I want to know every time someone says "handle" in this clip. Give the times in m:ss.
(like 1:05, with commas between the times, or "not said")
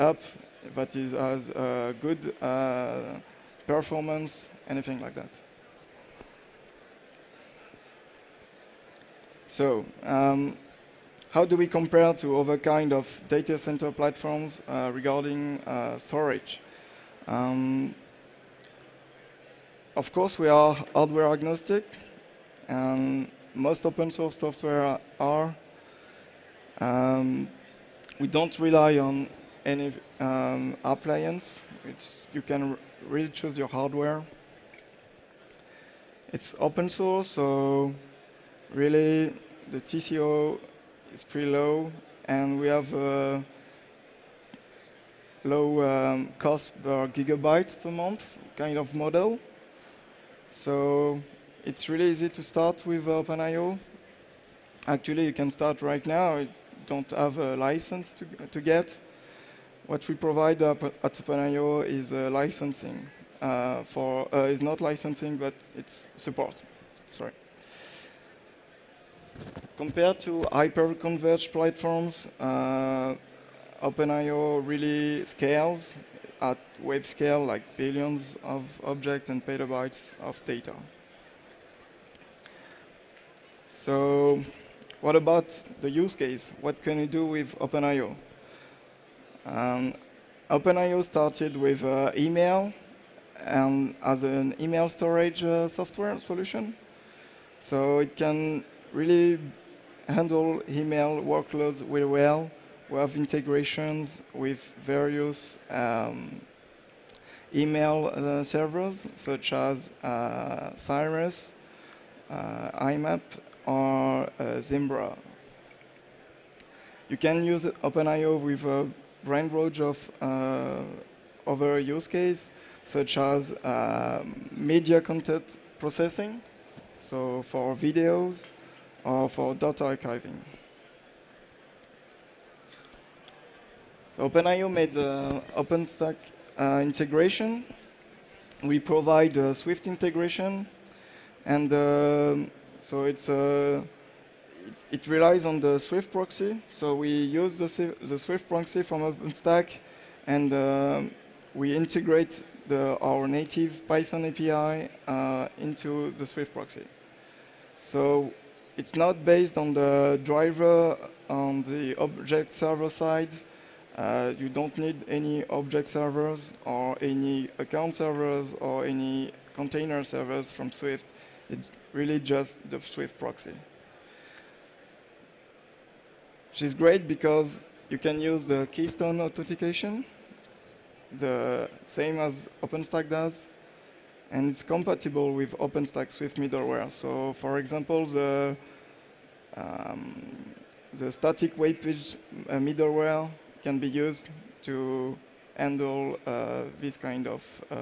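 1:40, 3:15.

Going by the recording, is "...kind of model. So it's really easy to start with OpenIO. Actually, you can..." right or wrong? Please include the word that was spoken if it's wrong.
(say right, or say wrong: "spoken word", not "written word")
right.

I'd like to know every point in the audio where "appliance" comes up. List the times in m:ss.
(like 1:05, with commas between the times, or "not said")
0:30.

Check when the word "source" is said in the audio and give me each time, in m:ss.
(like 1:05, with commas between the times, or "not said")
0:24, 0:36.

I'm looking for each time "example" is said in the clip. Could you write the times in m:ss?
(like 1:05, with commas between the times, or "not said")
3:07.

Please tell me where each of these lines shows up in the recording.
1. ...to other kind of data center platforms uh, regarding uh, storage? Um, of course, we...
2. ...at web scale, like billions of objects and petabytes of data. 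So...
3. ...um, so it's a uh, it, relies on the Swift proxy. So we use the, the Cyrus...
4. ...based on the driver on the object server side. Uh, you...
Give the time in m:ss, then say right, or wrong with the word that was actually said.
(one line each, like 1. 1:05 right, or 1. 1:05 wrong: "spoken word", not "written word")
1. 0:12 right
2. 1:16 right
3. 2:21 wrong: "Swift", not "Cyrus"
4. 2:39 right.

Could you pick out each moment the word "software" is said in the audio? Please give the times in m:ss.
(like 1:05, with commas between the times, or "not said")
0:24, 1:35.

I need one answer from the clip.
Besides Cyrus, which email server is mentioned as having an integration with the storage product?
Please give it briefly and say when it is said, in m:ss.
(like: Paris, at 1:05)
Zimbra, at 1:54.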